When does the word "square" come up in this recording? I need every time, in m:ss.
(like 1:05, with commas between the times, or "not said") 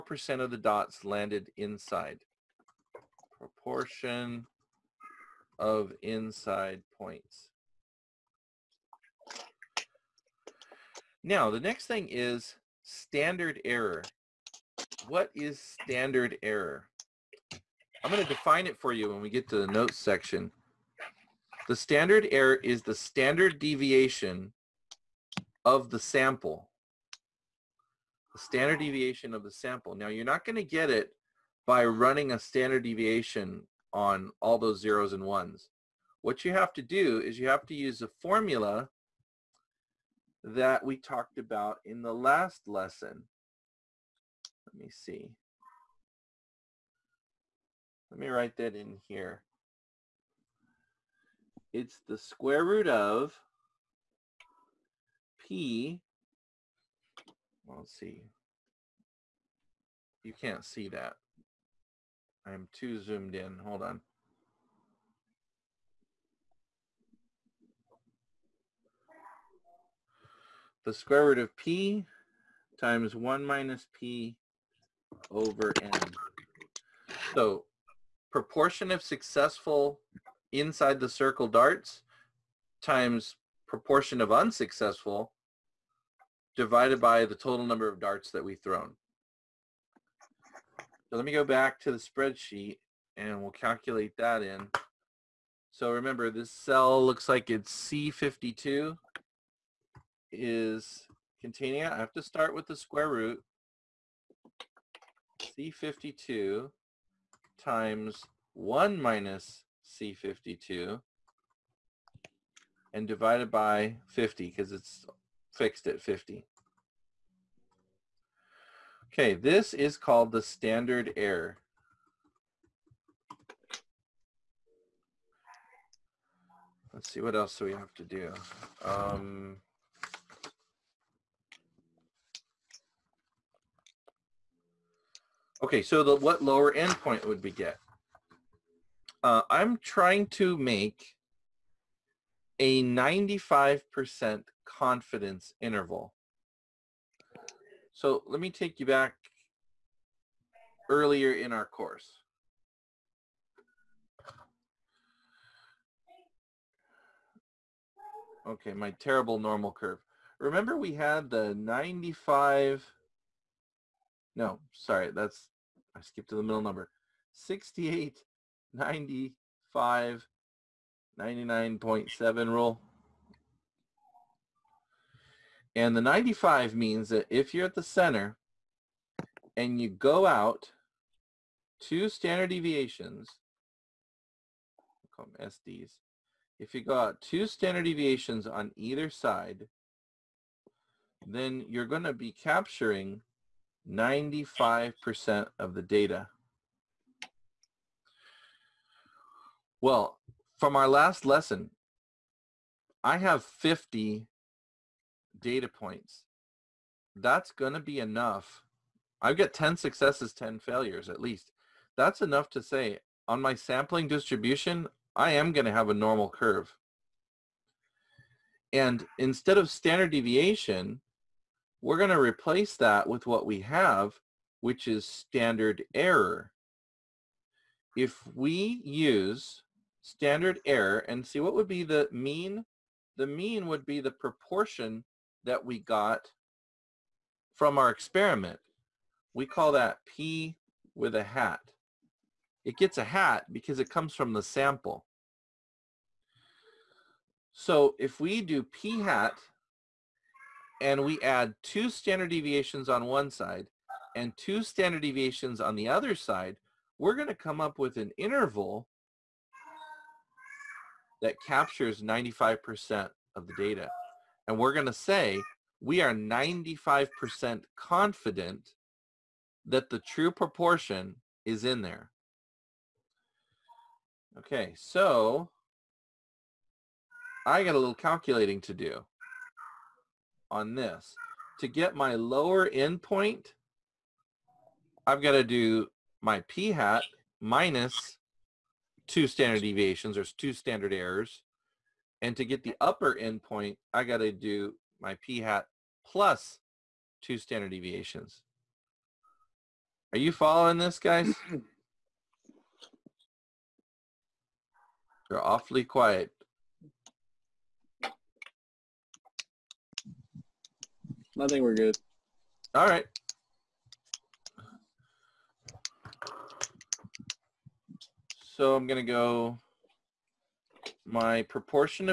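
0:52, 1:10, 1:42.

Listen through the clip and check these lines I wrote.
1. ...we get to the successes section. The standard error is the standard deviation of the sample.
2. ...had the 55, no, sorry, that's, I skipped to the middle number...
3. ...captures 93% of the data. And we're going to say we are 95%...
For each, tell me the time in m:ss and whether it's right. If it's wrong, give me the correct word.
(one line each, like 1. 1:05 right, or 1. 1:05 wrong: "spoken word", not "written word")
1. 0:19 wrong: "notes", not "successes"
2. 2:40 wrong: "95", not "55"
3. 4:21 wrong: "95", not "93".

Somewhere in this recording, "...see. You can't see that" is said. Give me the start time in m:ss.
0:57.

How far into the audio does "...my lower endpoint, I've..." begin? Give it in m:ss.
4:41.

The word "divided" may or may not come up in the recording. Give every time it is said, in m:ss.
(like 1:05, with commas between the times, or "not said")
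1:26, 1:53.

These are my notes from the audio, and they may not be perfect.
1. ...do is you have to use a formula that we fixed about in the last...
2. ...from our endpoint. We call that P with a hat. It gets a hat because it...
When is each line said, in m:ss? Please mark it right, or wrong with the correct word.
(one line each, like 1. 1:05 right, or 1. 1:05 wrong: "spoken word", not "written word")
1. 0:36 wrong: "talked", not "fixed"
2. 3:57 wrong: "experiment", not "endpoint".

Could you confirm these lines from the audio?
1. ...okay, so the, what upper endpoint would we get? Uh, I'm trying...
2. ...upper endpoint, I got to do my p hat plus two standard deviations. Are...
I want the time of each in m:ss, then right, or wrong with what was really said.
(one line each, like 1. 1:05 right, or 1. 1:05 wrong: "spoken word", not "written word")
1. 2:15 wrong: "lower", not "upper"
2. 4:52 right.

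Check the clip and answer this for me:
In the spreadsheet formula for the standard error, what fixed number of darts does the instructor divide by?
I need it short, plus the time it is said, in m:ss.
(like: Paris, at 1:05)
50, at 1:53.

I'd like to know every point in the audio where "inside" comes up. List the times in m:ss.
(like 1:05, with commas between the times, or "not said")
0:01, 0:06, 1:20.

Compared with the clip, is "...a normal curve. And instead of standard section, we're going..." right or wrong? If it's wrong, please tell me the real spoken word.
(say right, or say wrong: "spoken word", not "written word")
wrong: "deviation", not "section".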